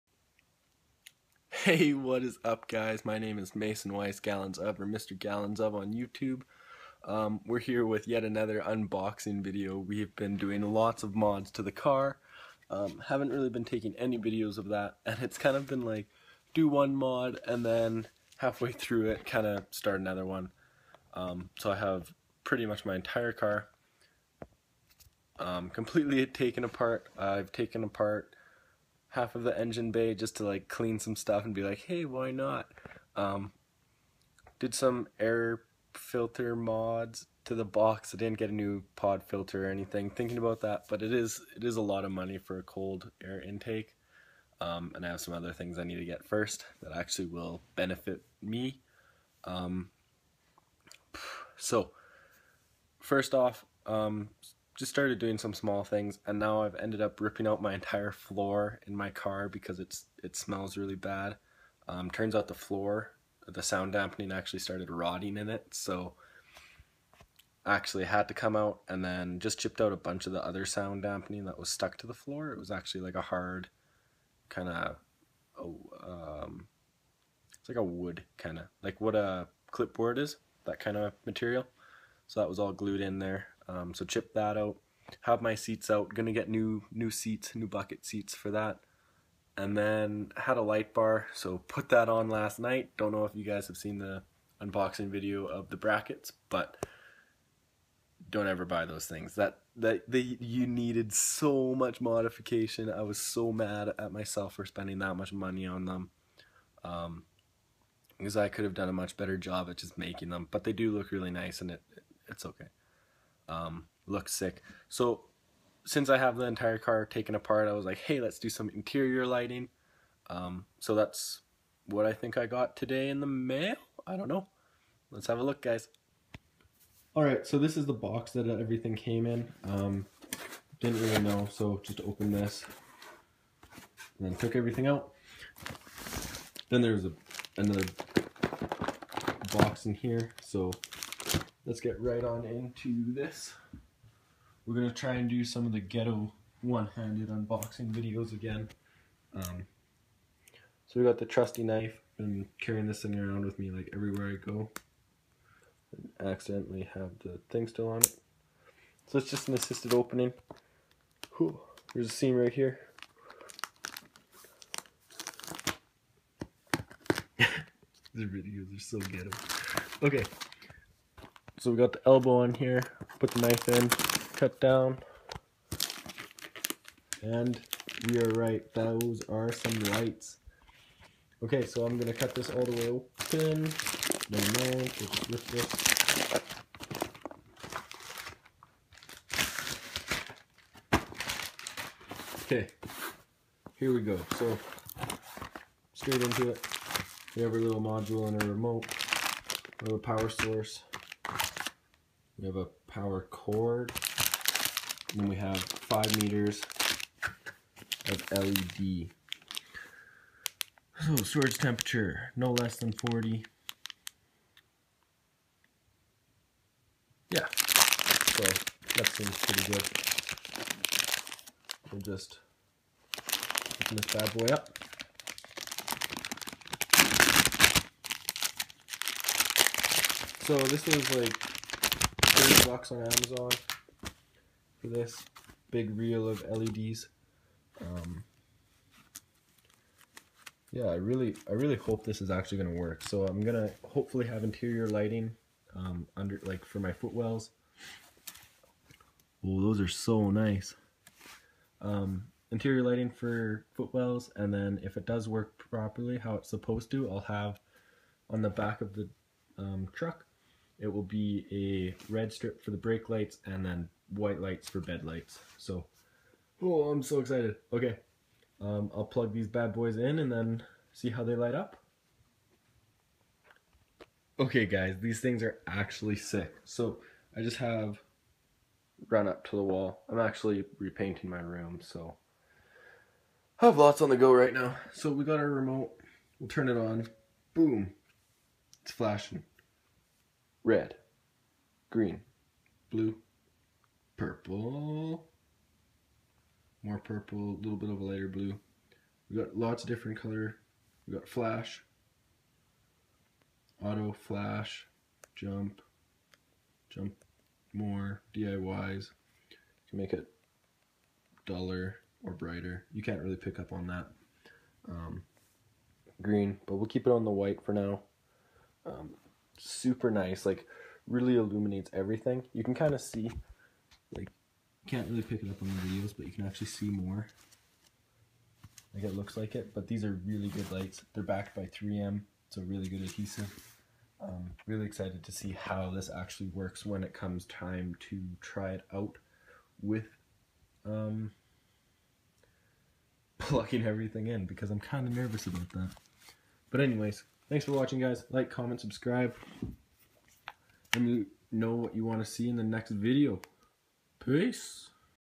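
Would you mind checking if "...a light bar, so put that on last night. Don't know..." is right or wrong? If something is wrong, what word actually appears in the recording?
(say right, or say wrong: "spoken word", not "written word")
right.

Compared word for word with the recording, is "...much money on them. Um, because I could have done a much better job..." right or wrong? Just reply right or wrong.
right.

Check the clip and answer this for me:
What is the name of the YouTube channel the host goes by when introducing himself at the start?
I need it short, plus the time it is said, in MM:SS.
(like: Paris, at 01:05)
Mr. Gallons of, at 00:04.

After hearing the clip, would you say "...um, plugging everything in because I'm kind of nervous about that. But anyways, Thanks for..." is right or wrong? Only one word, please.
right.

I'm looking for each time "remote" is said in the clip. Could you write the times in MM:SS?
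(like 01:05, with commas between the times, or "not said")
03:18, 04:45.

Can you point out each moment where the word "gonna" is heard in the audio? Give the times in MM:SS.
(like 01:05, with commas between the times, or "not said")
01:26, 03:01.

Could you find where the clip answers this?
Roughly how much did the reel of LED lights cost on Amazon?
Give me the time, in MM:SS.
03:52.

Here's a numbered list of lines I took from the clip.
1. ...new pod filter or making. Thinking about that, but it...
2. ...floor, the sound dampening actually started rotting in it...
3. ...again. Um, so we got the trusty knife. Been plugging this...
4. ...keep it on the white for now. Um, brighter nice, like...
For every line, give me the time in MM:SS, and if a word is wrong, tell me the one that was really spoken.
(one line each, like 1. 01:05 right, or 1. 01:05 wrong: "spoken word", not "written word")
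1. 00:38 wrong: "anything", not "making"
2. 01:02 right
3. 02:28 wrong: "carrying", not "plugging"
4. 05:16 wrong: "super", not "brighter".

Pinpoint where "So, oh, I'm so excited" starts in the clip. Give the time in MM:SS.
04:25.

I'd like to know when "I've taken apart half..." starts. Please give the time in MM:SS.
00:27.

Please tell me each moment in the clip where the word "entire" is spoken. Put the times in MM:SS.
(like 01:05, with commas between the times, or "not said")
00:22, 00:57, 01:56.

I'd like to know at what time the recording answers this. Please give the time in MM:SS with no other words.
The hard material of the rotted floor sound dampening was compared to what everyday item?
01:19.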